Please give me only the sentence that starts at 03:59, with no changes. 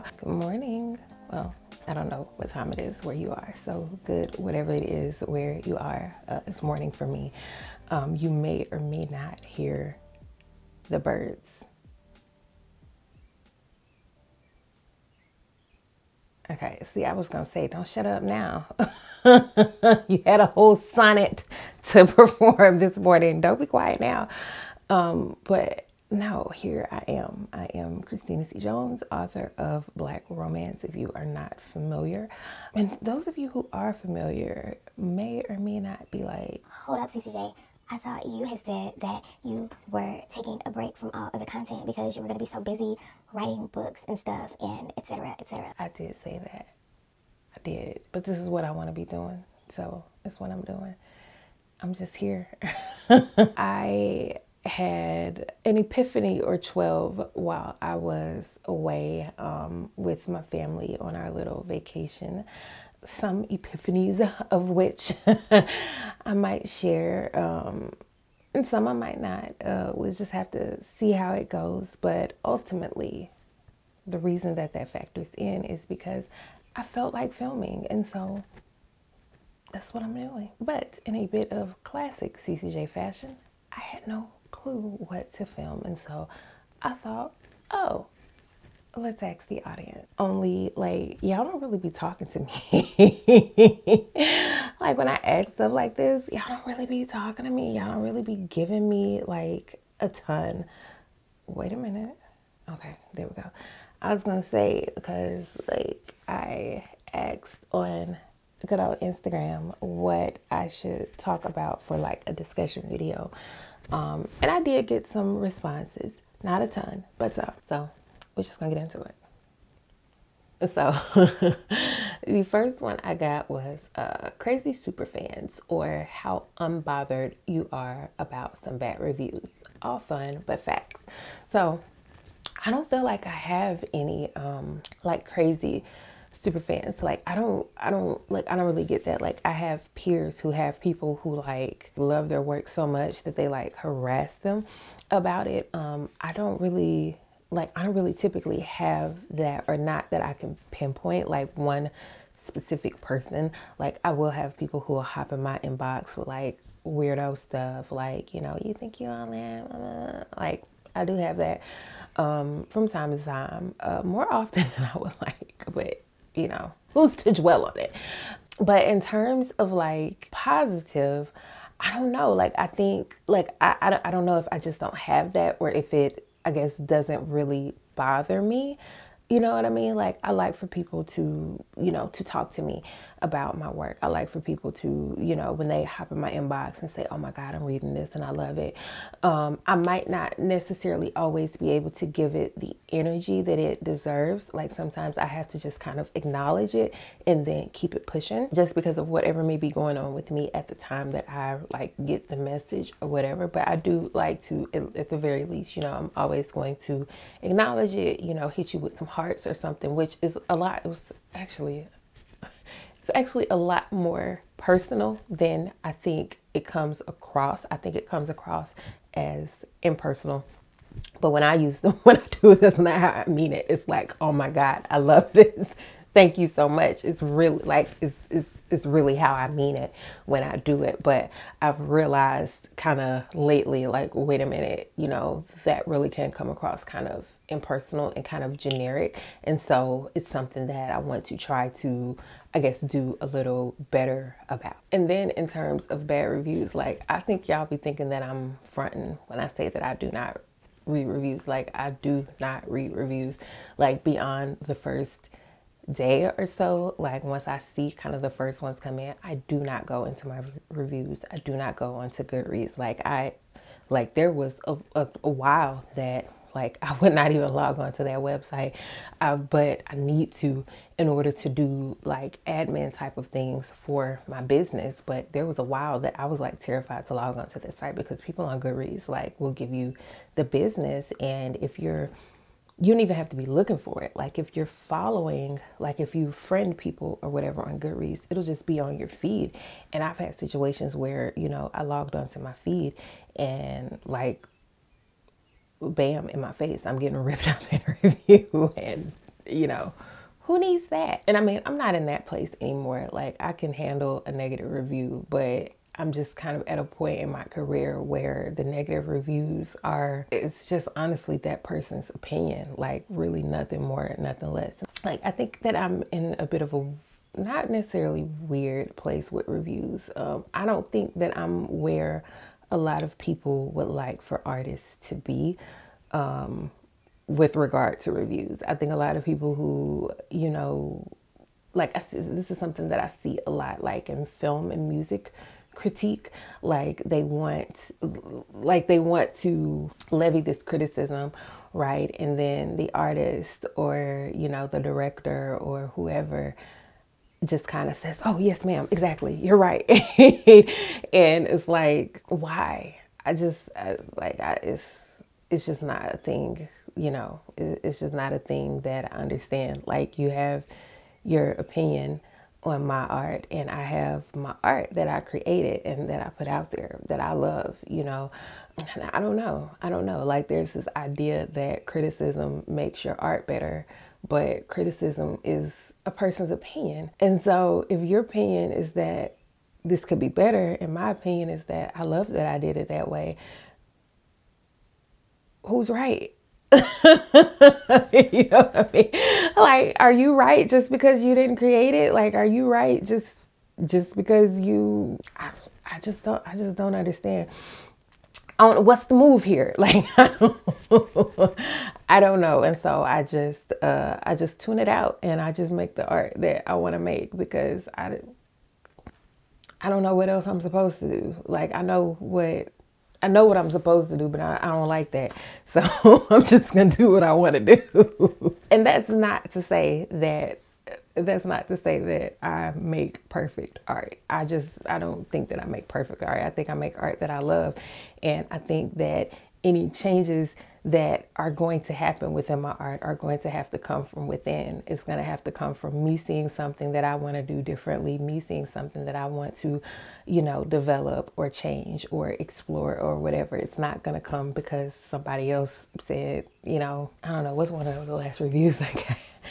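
And so it's something that I want to try to, I guess, do a little better about.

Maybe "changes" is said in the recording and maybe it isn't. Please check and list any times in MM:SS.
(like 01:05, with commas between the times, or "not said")
07:09, 07:21.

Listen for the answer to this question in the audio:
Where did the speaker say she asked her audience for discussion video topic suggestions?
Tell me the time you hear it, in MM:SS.
01:48.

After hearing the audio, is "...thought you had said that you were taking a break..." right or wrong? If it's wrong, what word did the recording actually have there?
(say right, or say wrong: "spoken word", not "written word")
right.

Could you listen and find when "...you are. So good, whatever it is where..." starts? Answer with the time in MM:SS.
00:03.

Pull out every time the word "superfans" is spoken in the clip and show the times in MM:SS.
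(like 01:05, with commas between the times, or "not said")
02:04, 02:16.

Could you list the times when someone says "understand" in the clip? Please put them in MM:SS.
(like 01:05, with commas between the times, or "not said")
05:59, 06:36.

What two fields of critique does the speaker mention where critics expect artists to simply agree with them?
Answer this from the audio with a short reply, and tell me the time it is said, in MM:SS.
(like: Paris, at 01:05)
film and music, at 05:34.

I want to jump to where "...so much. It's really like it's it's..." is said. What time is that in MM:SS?
03:46.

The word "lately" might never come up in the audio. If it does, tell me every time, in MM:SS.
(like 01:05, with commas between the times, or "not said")
03:53.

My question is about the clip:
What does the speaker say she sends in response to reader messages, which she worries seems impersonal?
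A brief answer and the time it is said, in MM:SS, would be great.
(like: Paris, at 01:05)
hearts, at 03:29.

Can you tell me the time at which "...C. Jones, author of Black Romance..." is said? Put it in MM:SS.
00:28.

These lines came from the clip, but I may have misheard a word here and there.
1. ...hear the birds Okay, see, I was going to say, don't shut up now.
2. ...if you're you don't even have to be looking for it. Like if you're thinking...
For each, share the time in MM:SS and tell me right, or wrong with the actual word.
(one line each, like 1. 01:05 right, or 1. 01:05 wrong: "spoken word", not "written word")
1. 00:09 right
2. 04:41 wrong: "following", not "thinking".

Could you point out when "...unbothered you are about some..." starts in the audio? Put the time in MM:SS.
02:06.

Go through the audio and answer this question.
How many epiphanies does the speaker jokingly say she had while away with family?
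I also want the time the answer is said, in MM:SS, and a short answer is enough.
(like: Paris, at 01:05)
12, at 00:56.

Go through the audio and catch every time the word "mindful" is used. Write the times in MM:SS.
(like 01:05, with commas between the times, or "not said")
not said.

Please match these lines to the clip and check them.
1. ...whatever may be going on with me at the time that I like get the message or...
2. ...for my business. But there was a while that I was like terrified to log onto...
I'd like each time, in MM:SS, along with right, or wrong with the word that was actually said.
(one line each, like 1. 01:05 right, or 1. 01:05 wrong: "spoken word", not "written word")
1. 03:19 right
2. 04:33 right.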